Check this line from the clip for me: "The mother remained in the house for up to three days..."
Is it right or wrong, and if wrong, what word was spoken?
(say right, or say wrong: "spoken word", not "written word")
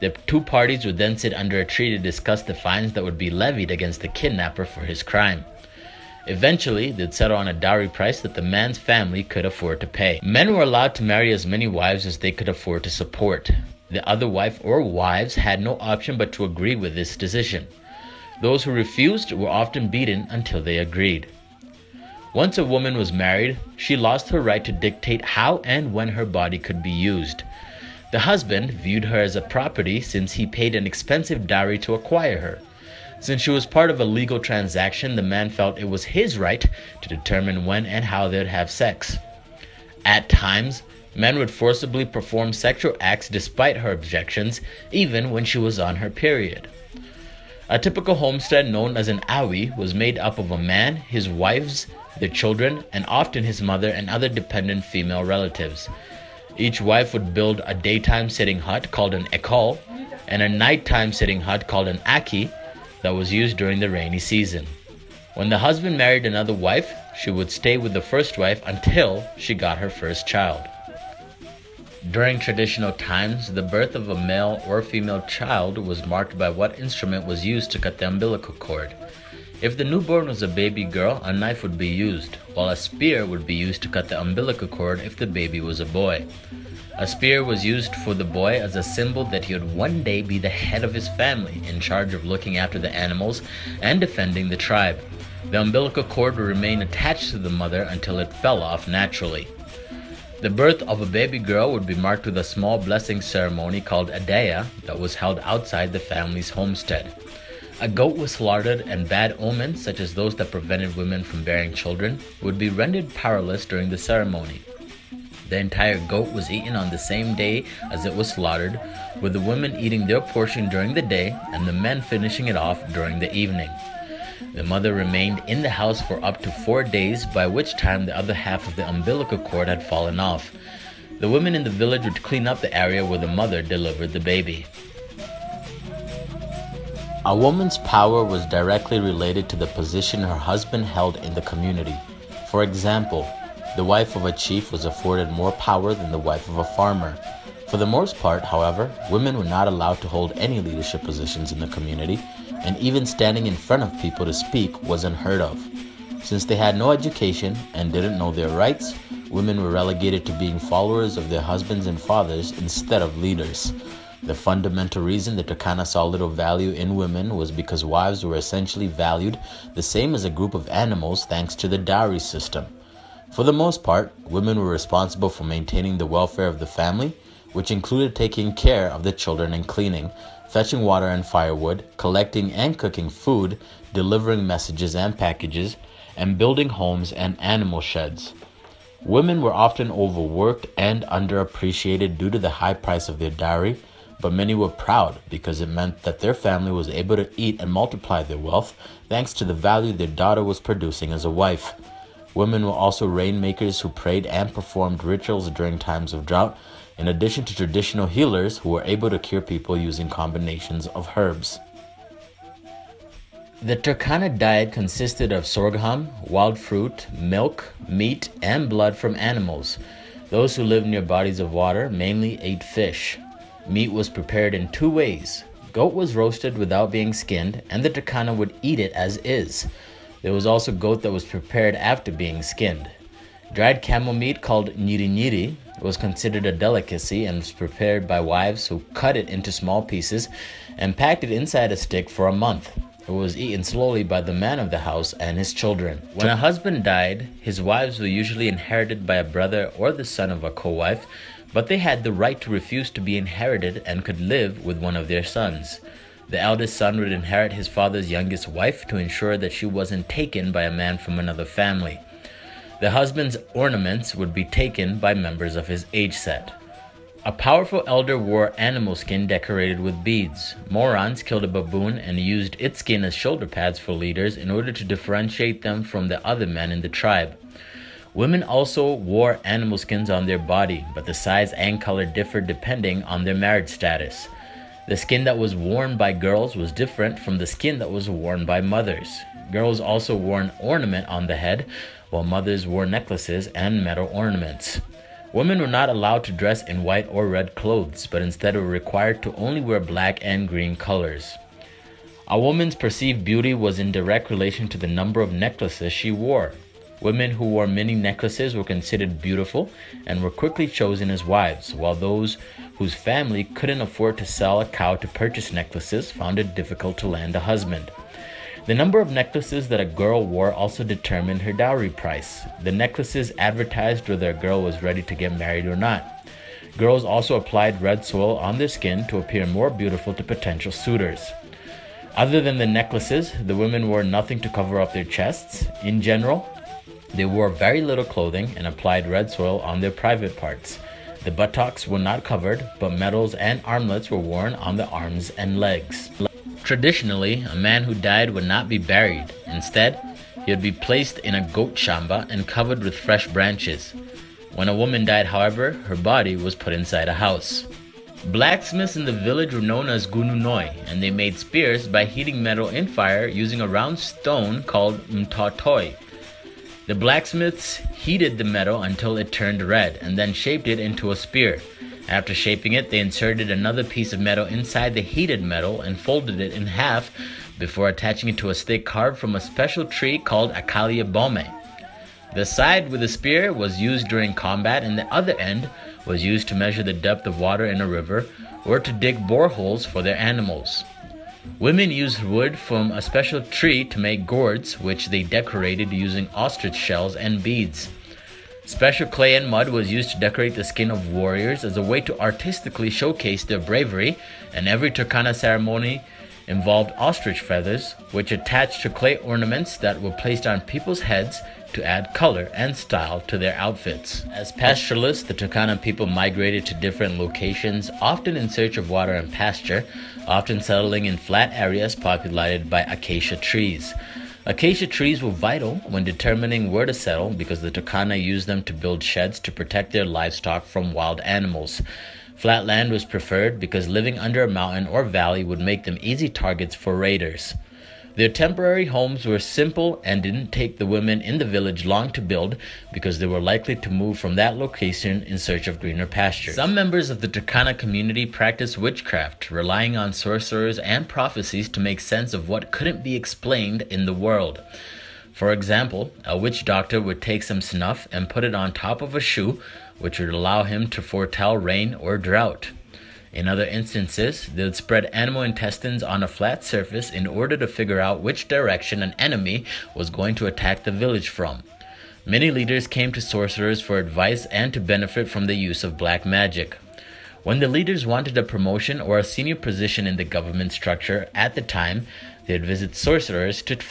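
wrong: "four", not "three".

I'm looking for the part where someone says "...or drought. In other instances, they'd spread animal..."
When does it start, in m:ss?
7:41.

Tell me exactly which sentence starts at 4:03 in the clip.
It was eaten slowly by the man of the house and his children.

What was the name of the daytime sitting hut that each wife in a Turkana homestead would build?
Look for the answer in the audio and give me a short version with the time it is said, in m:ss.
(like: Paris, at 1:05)
ekol, at 0:59.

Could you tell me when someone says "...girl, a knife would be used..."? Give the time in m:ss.
1:20.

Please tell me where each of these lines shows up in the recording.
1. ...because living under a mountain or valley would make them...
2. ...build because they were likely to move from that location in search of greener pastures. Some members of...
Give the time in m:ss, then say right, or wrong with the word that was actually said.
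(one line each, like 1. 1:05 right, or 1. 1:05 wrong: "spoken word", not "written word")
1. 7:13 right
2. 7:22 right.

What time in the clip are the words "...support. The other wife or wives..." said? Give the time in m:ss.
0:12.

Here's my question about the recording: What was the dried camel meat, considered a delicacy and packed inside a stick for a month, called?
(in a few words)
niri niri.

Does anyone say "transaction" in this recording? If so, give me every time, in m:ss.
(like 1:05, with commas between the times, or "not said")
0:34.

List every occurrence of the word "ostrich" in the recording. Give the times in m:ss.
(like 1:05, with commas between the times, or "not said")
6:36, 6:46.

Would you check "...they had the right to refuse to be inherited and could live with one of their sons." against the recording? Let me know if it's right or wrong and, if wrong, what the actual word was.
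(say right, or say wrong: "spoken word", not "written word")
right.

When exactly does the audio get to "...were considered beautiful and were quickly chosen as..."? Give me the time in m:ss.
5:08.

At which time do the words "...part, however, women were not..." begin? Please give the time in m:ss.
2:28.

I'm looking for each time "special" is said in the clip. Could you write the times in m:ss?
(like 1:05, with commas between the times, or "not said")
6:19, 6:33, 6:38.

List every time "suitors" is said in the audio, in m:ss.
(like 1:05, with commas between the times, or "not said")
5:30.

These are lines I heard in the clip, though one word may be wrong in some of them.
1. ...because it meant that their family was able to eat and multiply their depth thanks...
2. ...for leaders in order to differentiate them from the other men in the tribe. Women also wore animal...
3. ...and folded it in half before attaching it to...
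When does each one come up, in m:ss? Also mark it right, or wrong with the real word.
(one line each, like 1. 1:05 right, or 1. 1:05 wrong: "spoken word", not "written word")
1. 3:15 wrong: "wealth", not "depth"
2. 4:33 right
3. 6:15 right.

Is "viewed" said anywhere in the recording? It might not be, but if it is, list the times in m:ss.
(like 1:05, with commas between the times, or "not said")
0:28.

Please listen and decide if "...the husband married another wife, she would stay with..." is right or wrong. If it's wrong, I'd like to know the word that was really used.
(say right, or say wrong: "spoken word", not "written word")
right.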